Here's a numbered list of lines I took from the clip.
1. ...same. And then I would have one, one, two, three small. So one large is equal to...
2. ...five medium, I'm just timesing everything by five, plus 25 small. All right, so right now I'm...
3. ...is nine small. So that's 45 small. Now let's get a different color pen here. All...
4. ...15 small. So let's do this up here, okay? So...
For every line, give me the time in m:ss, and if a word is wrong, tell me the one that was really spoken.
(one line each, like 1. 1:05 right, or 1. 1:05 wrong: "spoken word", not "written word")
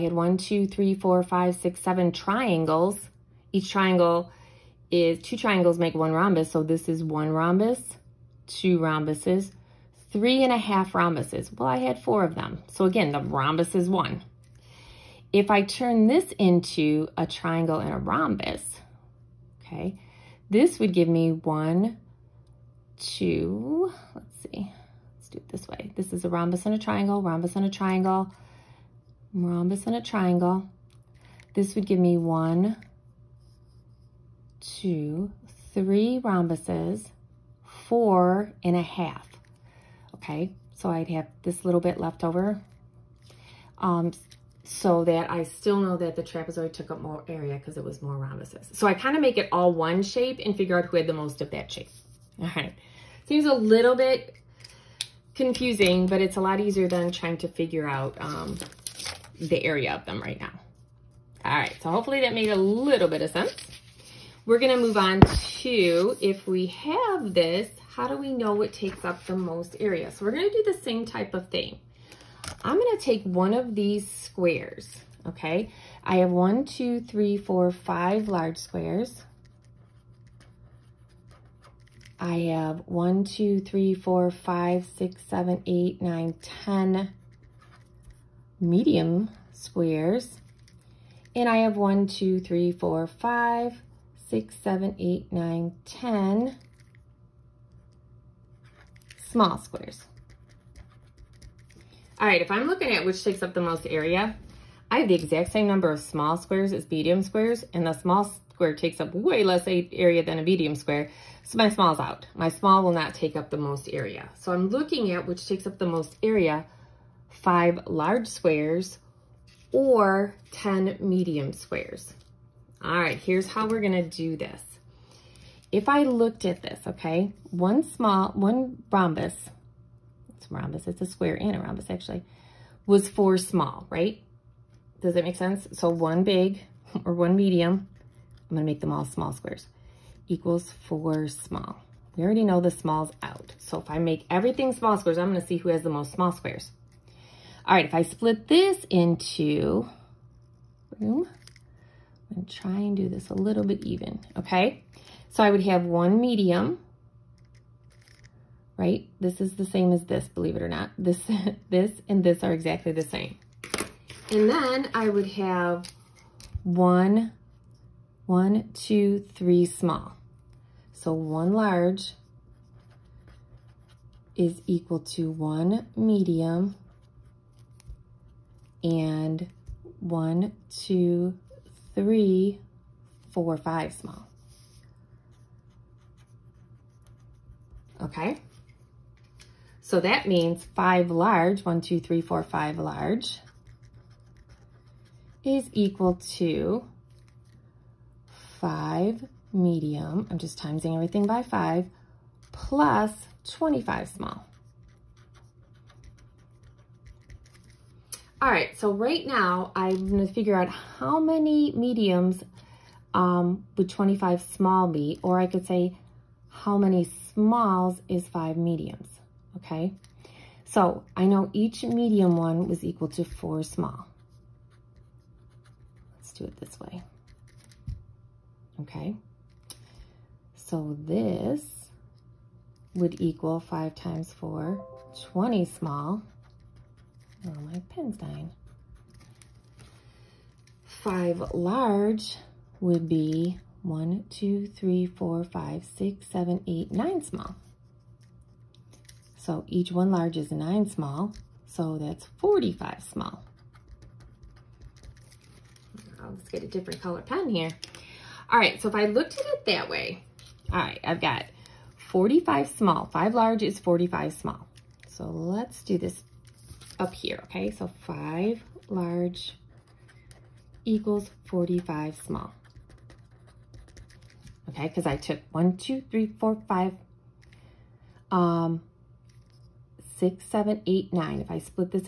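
1. 2:43 right
2. 3:18 right
3. 4:10 right
4. 4:23 wrong: "45", not "15".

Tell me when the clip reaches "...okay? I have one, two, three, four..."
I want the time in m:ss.
1:15.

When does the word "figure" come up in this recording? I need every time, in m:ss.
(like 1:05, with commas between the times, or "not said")
0:50, 0:57, 3:30.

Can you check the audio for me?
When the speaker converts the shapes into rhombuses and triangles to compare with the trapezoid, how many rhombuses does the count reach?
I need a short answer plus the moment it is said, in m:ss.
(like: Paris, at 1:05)
4 and a half, at 0:37.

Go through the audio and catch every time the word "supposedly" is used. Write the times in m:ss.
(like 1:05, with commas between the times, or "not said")
not said.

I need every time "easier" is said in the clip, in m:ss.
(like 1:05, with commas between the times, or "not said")
0:56.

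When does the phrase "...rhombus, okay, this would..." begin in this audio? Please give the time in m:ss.
0:17.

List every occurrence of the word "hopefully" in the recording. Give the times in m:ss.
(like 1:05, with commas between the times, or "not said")
1:01.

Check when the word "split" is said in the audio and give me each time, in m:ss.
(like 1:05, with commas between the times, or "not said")
2:28, 4:41.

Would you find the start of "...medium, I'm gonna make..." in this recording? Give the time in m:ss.
2:17.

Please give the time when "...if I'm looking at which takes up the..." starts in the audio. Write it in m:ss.
1:42.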